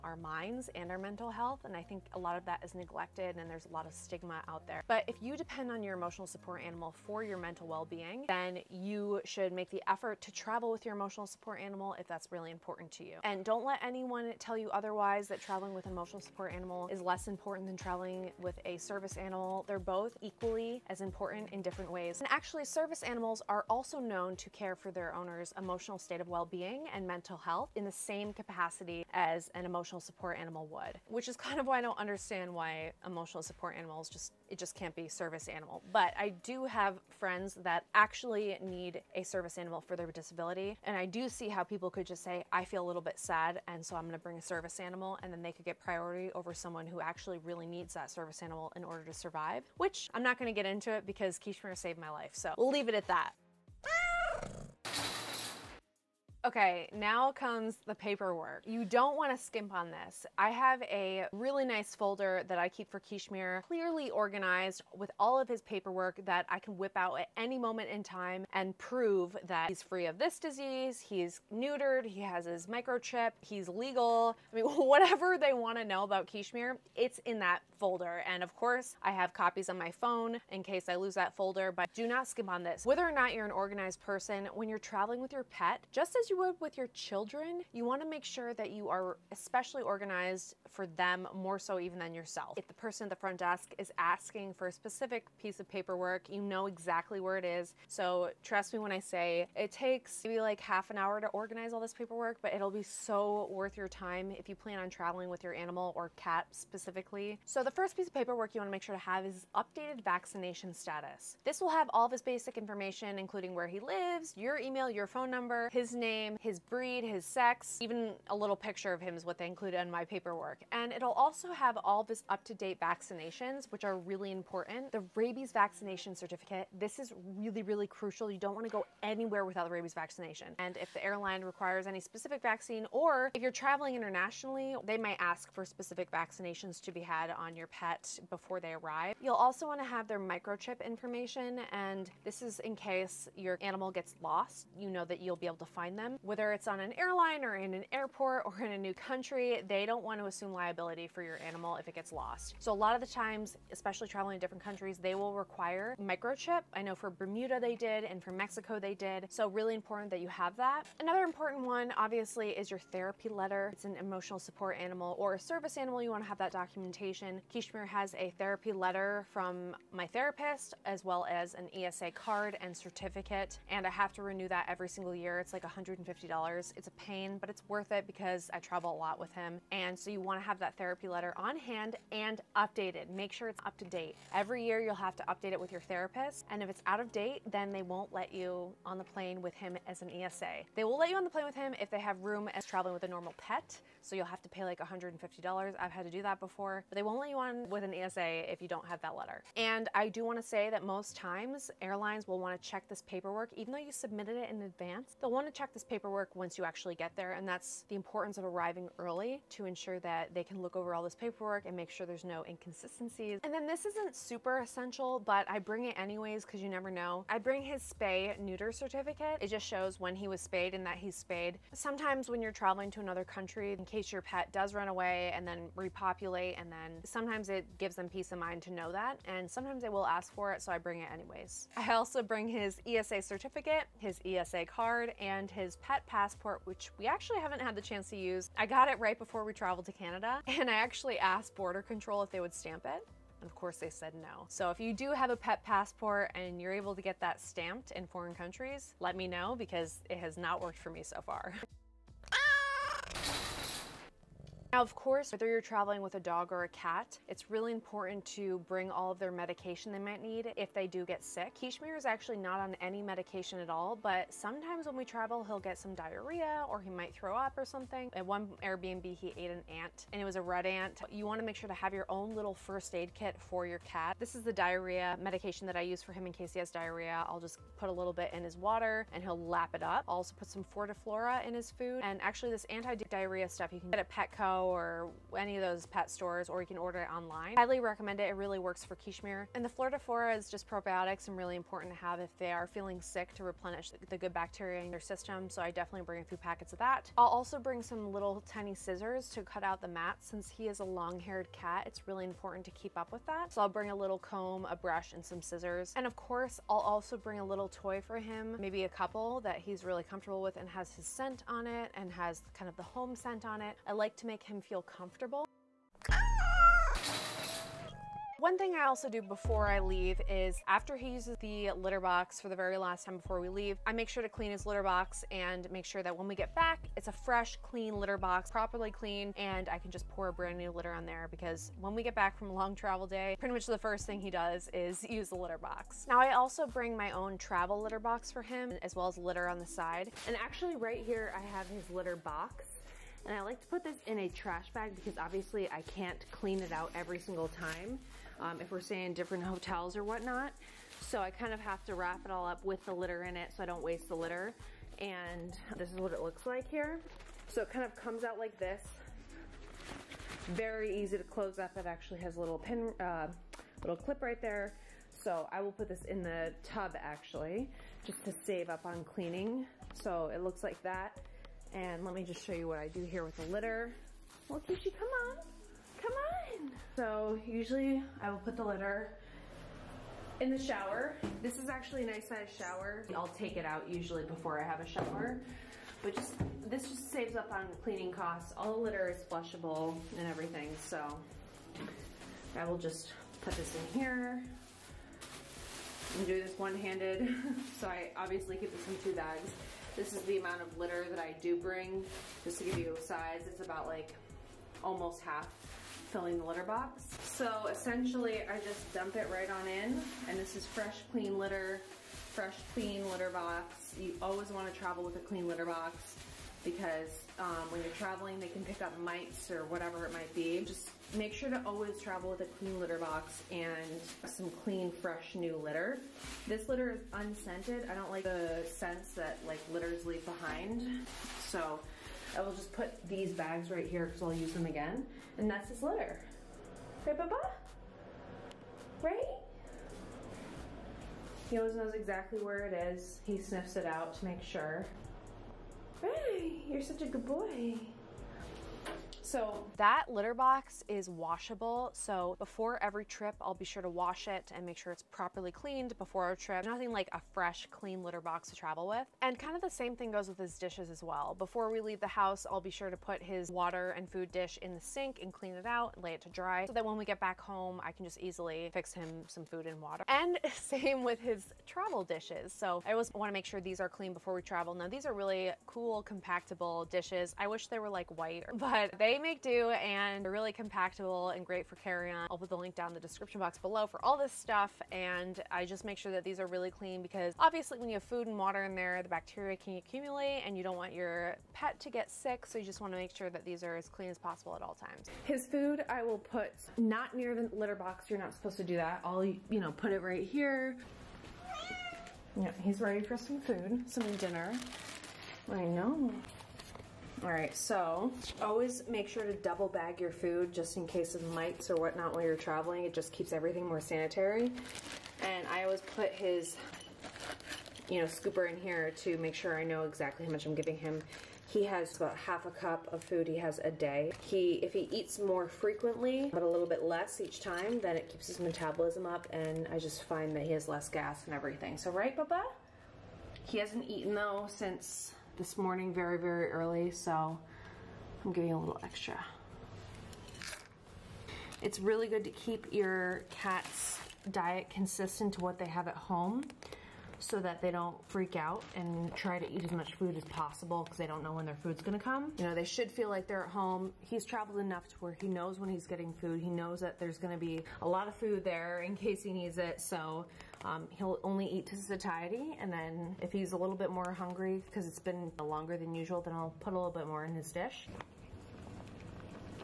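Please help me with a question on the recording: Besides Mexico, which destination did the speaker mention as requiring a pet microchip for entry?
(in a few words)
Bermuda.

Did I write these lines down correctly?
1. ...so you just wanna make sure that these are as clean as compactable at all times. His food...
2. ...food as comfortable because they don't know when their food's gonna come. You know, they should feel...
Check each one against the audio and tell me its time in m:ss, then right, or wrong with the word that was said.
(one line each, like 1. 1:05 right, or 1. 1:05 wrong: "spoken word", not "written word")
1. 8:12 wrong: "possible", not "compactable"
2. 9:09 wrong: "possible", not "comfortable".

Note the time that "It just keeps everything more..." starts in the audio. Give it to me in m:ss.
8:32.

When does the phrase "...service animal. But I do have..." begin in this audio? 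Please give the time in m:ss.
0:35.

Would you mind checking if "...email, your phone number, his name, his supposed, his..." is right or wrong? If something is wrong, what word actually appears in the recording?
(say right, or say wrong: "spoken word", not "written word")
wrong: "breed", not "supposed".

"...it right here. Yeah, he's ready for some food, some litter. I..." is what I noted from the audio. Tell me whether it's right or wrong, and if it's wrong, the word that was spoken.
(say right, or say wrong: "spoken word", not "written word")
wrong: "dinner", not "litter".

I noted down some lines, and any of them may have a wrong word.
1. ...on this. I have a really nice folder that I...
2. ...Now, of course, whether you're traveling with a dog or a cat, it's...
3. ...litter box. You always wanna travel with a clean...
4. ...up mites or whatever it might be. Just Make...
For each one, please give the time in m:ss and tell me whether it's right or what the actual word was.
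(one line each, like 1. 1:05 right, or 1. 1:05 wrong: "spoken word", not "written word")
1. 0:59 right
2. 4:14 right
3. 6:53 right
4. 6:58 right.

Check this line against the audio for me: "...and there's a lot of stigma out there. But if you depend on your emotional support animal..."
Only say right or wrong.
right.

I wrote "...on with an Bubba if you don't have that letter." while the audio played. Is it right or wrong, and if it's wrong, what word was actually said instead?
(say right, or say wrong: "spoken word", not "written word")
wrong: "ESA", not "Bubba".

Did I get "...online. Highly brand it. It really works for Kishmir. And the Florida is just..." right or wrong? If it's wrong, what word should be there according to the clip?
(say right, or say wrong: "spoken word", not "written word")
wrong: "recommend", not "brand".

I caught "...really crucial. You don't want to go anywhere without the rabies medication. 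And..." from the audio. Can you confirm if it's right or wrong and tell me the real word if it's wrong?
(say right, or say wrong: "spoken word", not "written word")
wrong: "vaccination", not "medication".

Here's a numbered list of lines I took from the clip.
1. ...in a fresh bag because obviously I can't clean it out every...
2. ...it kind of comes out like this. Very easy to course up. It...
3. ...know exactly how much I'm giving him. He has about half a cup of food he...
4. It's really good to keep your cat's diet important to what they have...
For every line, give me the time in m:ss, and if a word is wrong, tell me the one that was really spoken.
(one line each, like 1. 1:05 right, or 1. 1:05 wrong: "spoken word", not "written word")
1. 5:44 wrong: "trash", not "fresh"
2. 5:57 wrong: "close", not "course"
3. 8:39 right
4. 9:01 wrong: "consistent", not "important".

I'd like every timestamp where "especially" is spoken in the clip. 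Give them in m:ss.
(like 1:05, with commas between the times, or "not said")
1:29, 2:33.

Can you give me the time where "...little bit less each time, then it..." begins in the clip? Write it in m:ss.
8:46.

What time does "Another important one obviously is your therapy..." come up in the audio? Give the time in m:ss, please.
2:41.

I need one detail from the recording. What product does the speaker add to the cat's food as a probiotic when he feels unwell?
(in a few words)
Fortiflora.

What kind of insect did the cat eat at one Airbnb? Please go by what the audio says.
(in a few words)
red ant.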